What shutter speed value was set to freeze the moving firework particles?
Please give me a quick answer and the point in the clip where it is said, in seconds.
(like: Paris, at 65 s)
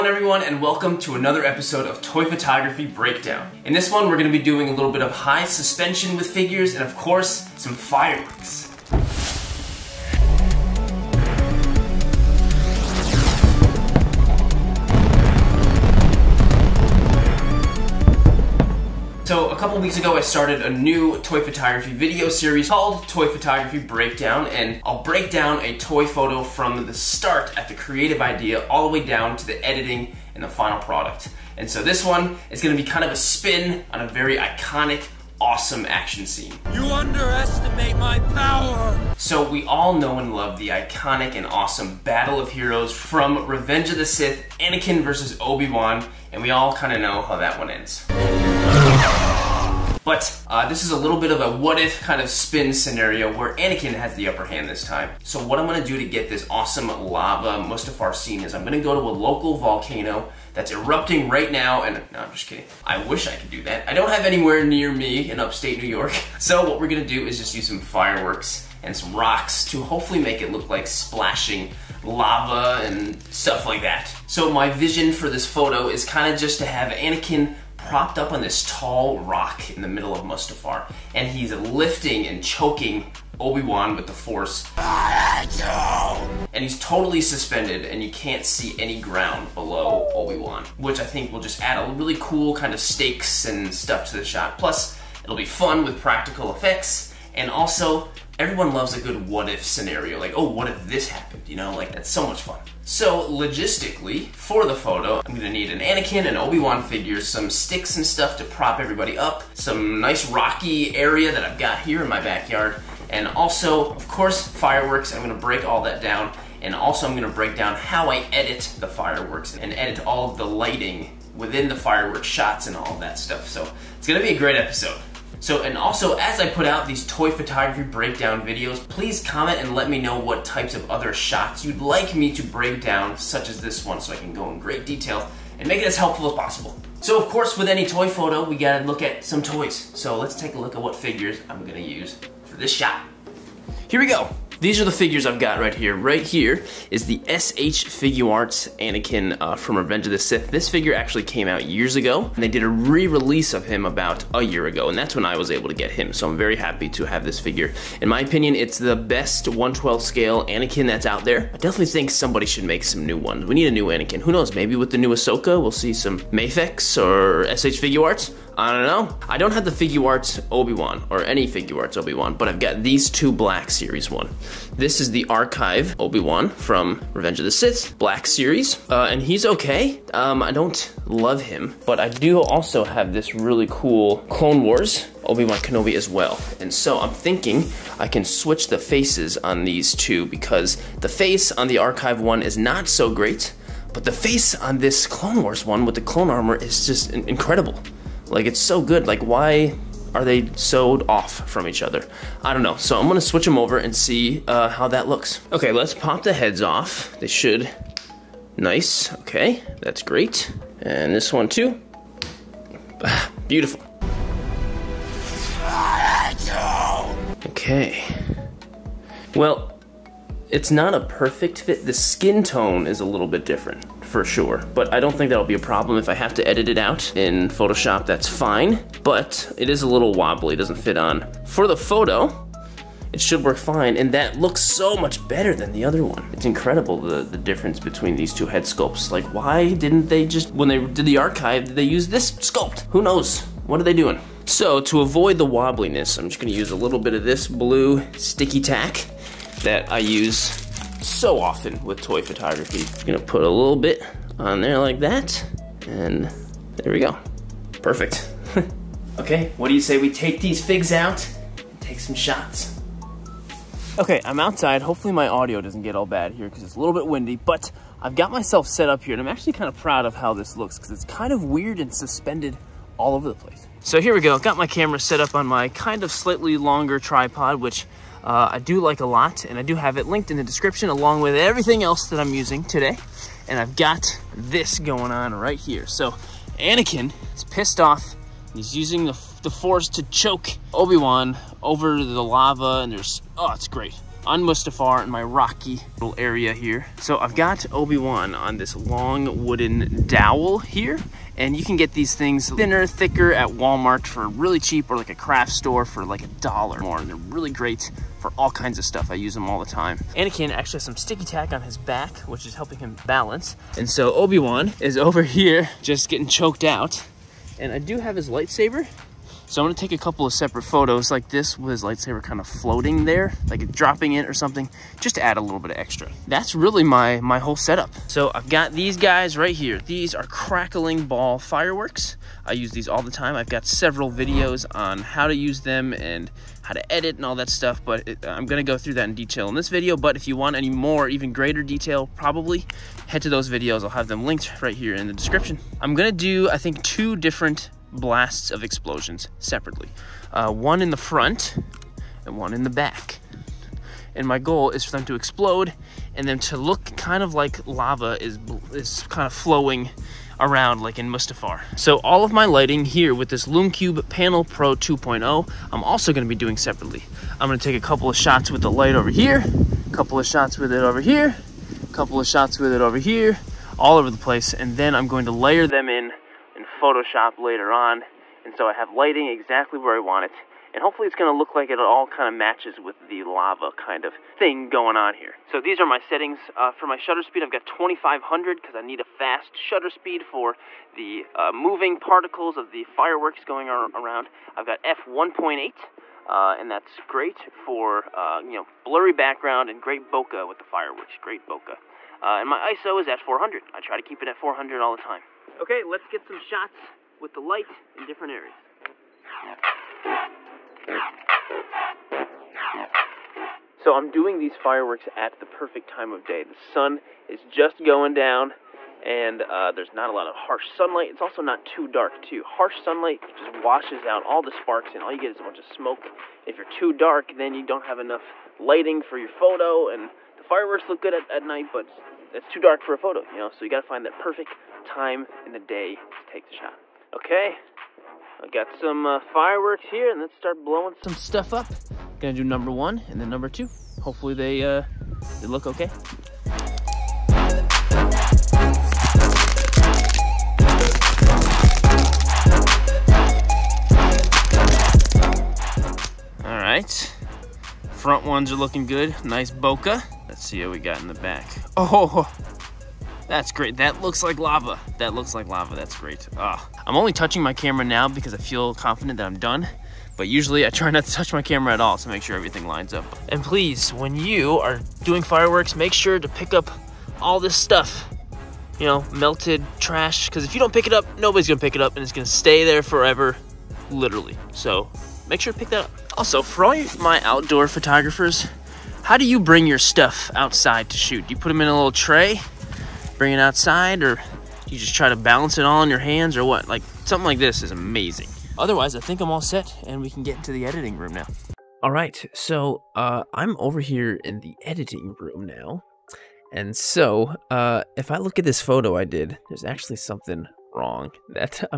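2500, at 387 s.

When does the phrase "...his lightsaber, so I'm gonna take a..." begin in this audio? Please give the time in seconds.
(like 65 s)
318 s.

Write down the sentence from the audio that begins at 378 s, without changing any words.
And so I have lighting exactly where I want it.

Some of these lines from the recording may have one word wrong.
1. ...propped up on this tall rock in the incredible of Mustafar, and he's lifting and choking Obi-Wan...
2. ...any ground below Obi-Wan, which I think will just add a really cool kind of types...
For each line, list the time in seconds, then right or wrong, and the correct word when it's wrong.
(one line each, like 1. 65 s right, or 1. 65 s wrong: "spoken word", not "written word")
1. 77 s wrong: "middle", not "incredible"
2. 88 s wrong: "stakes", not "types".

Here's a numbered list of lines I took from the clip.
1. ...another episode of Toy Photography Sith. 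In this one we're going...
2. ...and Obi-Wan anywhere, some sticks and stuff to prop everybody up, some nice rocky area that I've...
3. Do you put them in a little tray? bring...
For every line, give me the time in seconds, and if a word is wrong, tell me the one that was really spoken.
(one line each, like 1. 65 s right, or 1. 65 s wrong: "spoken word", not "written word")
1. 1 s wrong: "Breakdown", not "Sith"
2. 106 s wrong: "figure", not "anywhere"
3. 491 s right.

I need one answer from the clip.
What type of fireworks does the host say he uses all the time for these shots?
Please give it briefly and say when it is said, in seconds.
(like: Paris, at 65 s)
crackling ball fireworks, at 330 s.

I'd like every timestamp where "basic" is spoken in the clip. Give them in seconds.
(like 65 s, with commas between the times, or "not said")
not said.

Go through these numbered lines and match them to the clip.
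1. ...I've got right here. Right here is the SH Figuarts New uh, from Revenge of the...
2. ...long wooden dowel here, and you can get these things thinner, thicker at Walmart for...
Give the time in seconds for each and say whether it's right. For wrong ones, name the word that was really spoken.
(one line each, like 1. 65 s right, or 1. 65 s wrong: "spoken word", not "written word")
1. 145 s wrong: "Anakin", not "New"
2. 298 s right.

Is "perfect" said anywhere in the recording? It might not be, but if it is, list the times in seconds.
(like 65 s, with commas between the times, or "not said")
221 s, 257 s, 415 s, 434 s.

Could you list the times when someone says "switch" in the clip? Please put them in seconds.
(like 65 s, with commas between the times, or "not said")
188 s, 203 s.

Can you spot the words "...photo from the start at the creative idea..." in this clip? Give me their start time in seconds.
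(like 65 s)
26 s.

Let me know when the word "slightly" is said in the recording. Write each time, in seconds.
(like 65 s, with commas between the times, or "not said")
276 s.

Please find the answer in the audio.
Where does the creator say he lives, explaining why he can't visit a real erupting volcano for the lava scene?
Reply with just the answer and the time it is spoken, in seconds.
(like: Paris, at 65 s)
upstate New York, at 65 s.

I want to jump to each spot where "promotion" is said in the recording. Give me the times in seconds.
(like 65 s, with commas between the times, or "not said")
not said.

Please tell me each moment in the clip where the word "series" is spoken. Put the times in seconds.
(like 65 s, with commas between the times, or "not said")
22 s, 173 s, 178 s.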